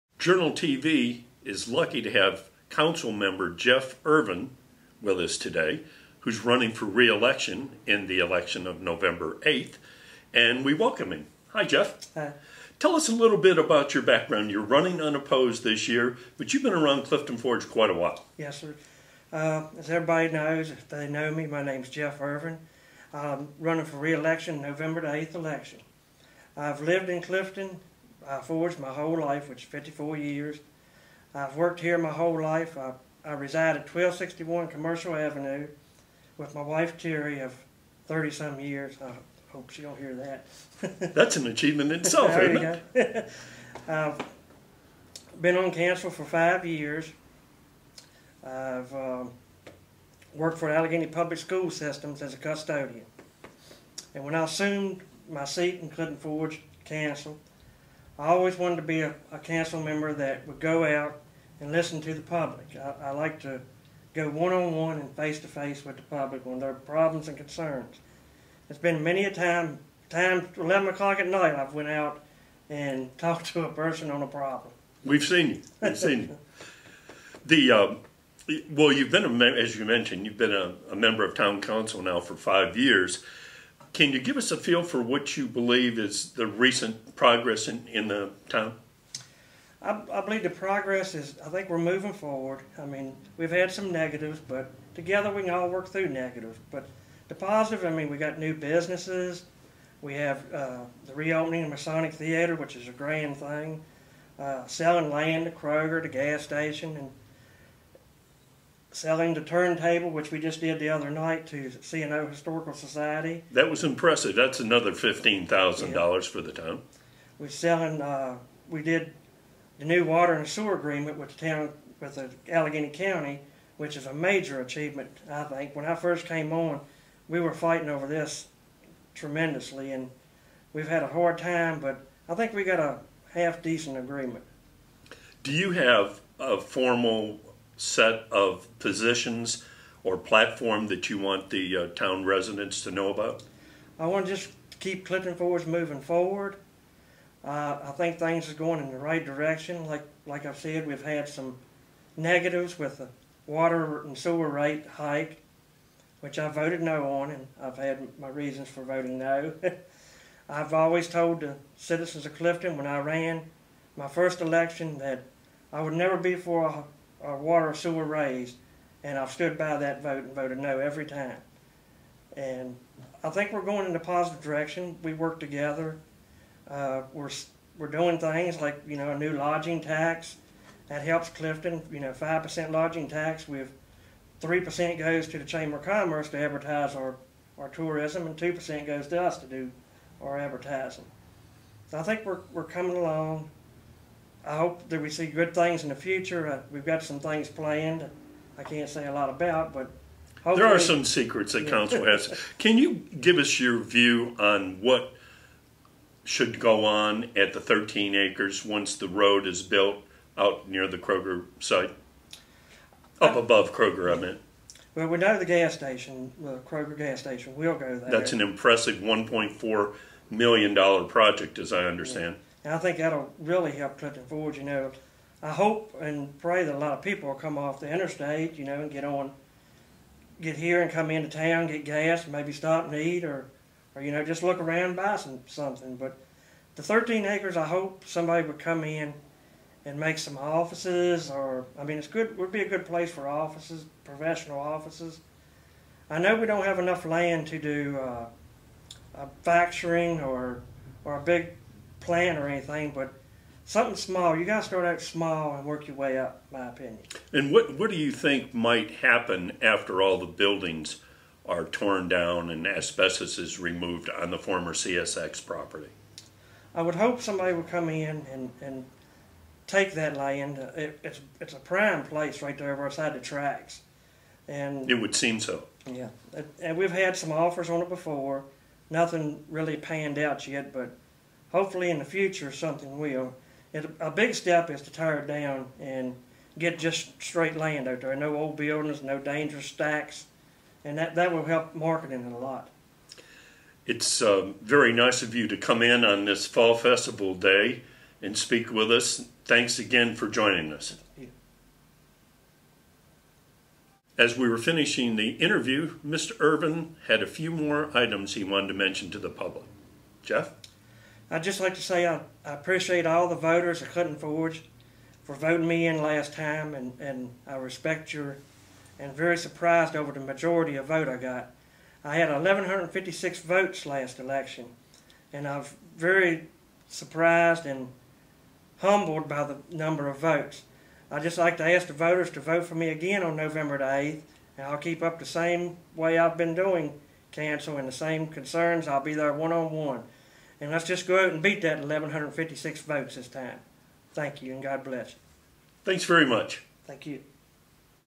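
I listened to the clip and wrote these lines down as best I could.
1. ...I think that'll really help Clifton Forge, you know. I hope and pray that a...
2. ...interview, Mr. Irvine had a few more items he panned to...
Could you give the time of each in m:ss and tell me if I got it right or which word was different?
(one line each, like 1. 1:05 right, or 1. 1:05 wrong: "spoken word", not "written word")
1. 3:42 right
2. 5:05 wrong: "wanted", not "panned".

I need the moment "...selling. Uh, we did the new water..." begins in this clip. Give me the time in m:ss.
1:57.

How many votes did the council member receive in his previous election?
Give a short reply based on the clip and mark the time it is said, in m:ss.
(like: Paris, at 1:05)
1,156, at 5:22.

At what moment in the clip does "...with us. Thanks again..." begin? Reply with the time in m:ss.
4:58.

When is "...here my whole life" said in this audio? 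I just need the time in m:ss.
0:31.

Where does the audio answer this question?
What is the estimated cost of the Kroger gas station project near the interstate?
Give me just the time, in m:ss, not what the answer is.
3:39.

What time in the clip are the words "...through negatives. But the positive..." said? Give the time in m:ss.
1:35.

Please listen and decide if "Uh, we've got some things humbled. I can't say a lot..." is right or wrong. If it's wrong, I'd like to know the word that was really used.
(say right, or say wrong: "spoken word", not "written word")
wrong: "planned", not "humbled".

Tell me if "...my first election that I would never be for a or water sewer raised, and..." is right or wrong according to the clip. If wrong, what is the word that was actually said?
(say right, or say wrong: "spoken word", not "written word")
right.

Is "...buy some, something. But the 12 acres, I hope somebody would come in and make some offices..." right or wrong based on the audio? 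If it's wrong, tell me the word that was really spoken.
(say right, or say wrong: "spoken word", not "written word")
wrong: "13", not "12".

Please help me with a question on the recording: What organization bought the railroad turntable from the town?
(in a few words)
C&O Historical Society.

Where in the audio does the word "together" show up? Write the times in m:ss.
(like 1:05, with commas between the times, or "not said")
1:34, 2:55.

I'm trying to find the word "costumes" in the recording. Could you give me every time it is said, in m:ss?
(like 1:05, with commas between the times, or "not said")
not said.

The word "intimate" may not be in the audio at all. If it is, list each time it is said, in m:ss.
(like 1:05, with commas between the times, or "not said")
not said.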